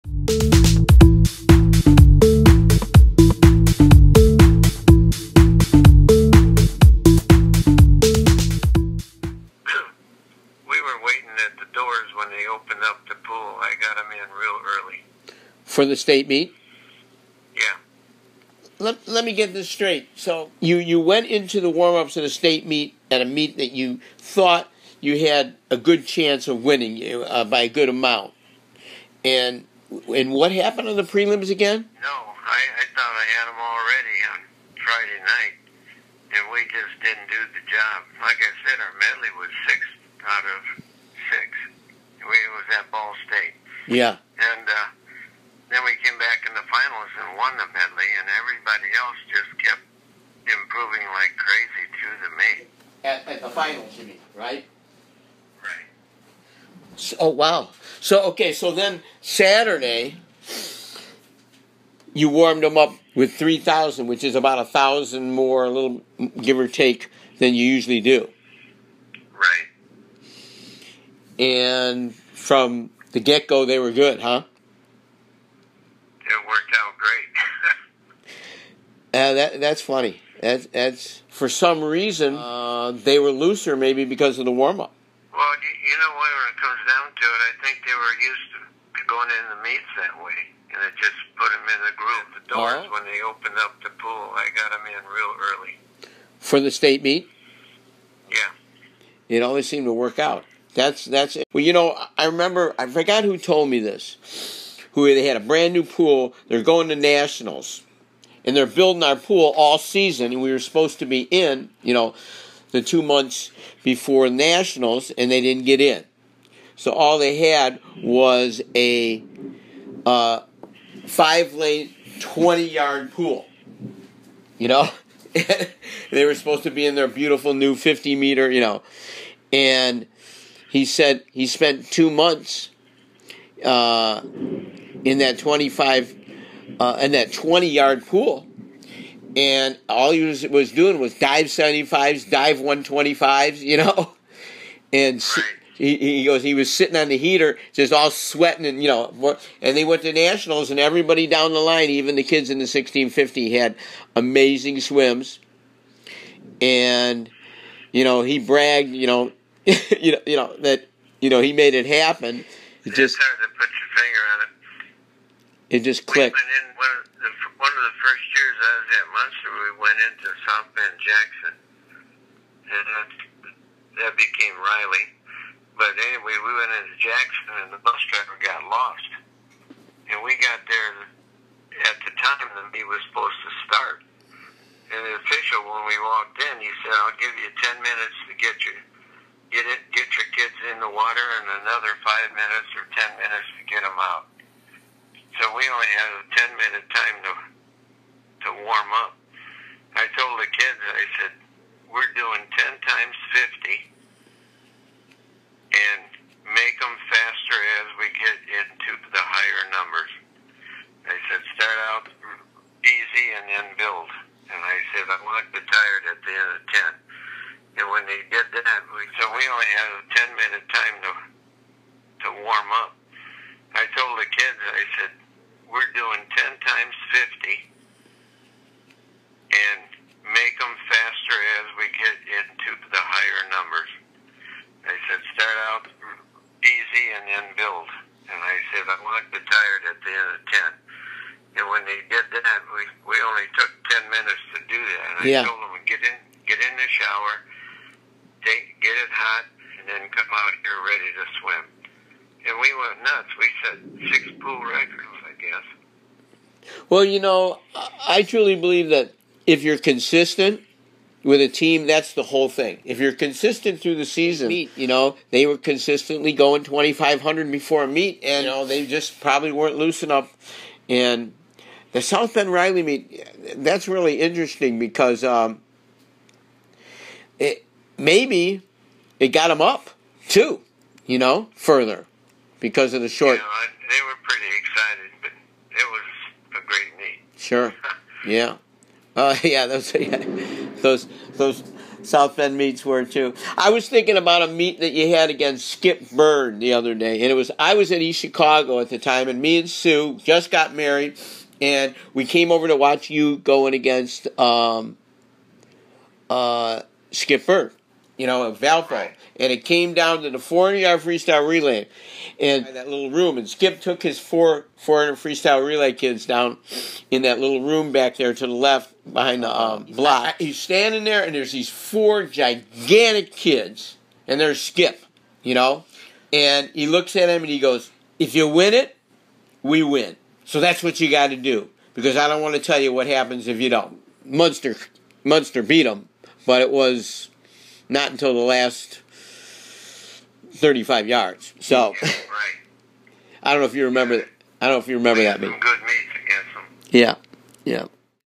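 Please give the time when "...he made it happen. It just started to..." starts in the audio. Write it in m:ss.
2:41.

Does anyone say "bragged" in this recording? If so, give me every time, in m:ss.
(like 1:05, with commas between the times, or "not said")
2:38.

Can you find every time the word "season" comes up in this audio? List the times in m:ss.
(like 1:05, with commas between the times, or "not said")
1:49, 4:24.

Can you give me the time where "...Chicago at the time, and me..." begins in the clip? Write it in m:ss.
4:58.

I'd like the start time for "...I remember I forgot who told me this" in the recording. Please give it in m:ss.
1:42.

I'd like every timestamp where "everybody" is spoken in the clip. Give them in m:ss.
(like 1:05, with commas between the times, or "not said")
0:48, 2:30.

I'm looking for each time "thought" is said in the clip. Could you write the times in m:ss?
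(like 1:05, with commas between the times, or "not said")
0:24, 0:32.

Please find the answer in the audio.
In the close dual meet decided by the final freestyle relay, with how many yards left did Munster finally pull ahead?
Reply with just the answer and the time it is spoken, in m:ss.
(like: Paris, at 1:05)
35 yards, at 5:38.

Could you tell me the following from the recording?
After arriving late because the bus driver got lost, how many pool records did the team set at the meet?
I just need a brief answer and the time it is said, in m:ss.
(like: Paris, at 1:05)
6, at 4:14.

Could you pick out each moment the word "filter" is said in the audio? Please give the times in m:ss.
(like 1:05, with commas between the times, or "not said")
not said.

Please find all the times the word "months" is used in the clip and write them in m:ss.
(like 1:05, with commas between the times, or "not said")
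1:53, 2:12.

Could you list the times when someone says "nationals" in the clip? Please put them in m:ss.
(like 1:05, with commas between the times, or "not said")
1:46, 1:54, 2:30.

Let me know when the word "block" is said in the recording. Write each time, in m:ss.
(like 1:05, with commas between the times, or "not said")
5:19.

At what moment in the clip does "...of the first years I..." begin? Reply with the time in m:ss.
2:47.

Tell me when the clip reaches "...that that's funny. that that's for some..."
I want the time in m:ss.
1:19.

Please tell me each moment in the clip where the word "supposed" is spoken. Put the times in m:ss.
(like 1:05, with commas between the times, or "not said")
1:50, 2:06, 3:03.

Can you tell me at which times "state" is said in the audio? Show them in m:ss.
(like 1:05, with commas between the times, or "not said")
0:15, 0:22, 0:43, 1:36.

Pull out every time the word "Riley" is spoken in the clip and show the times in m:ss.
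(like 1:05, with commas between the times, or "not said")
2:54, 4:32.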